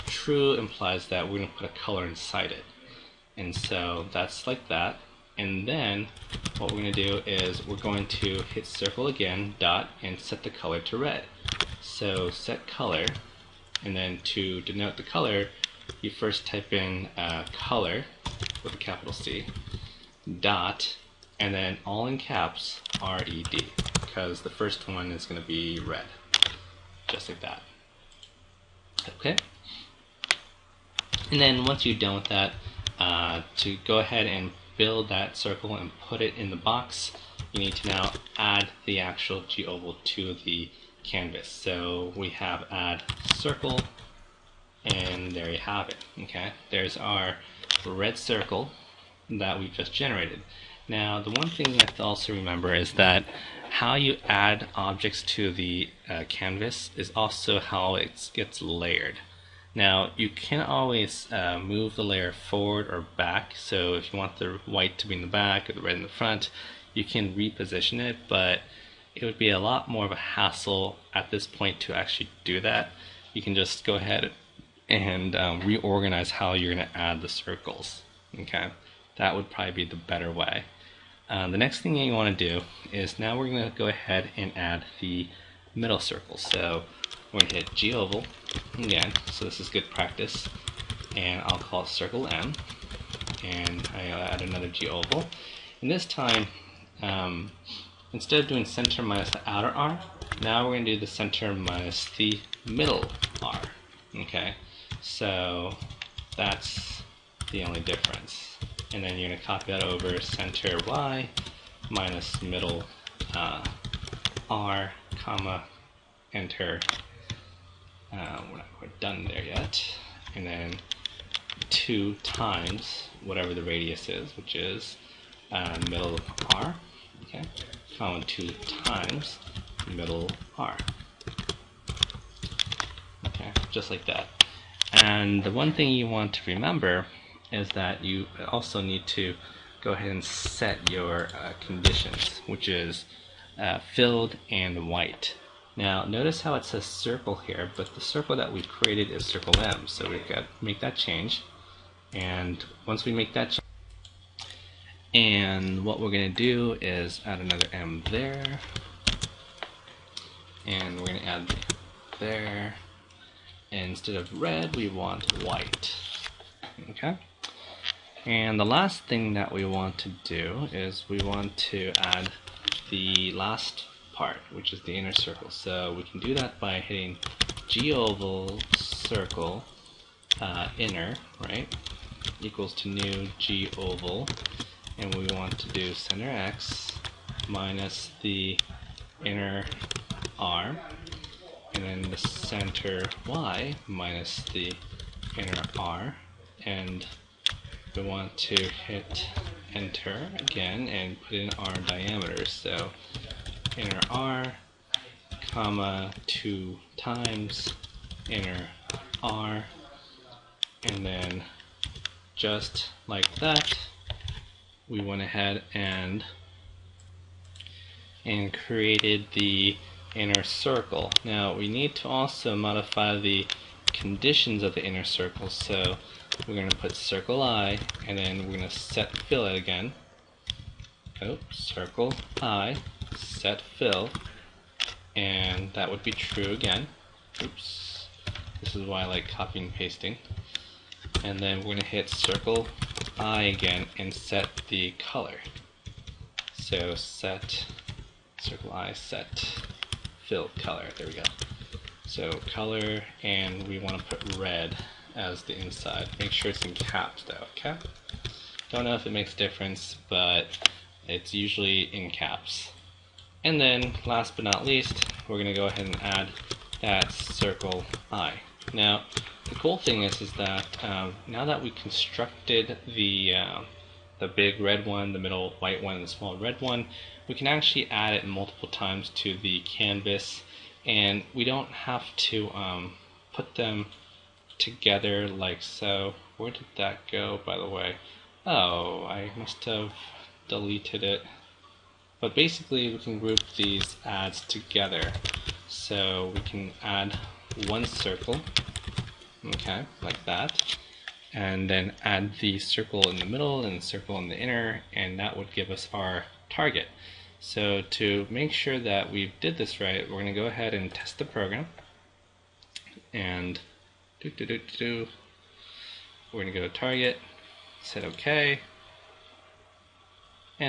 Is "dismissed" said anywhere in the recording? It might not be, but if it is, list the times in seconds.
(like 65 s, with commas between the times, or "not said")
not said.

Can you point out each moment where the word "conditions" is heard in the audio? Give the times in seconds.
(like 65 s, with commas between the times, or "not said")
141 s, 223 s.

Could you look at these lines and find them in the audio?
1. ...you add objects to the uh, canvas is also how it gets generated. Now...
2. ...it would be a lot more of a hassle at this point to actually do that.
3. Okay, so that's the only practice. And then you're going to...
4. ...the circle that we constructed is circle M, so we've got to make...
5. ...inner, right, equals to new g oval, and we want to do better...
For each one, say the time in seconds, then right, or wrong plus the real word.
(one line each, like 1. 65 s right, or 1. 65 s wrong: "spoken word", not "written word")
1. 53 s wrong: "layered", not "generated"
2. 69 s right
3. 104 s wrong: "difference", not "practice"
4. 147 s wrong: "created", not "constructed"
5. 180 s wrong: "center", not "better".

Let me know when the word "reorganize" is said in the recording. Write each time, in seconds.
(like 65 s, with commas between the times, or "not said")
75 s.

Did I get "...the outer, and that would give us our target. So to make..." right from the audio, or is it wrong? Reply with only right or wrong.
wrong.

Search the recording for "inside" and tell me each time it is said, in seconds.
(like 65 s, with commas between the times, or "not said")
2 s, 255 s.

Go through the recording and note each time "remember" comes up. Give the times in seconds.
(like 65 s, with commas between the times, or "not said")
52 s, 136 s.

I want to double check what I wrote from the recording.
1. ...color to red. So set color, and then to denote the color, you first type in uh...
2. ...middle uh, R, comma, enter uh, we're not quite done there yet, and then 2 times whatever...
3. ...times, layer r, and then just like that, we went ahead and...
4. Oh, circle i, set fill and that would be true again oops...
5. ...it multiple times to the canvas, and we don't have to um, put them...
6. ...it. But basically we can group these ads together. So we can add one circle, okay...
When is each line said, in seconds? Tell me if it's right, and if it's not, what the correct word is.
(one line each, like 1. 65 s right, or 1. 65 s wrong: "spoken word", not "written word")
1. 10 s right
2. 112 s right
3. 206 s wrong: "inner", not "layer"
4. 231 s right
5. 278 s right
6. 291 s right.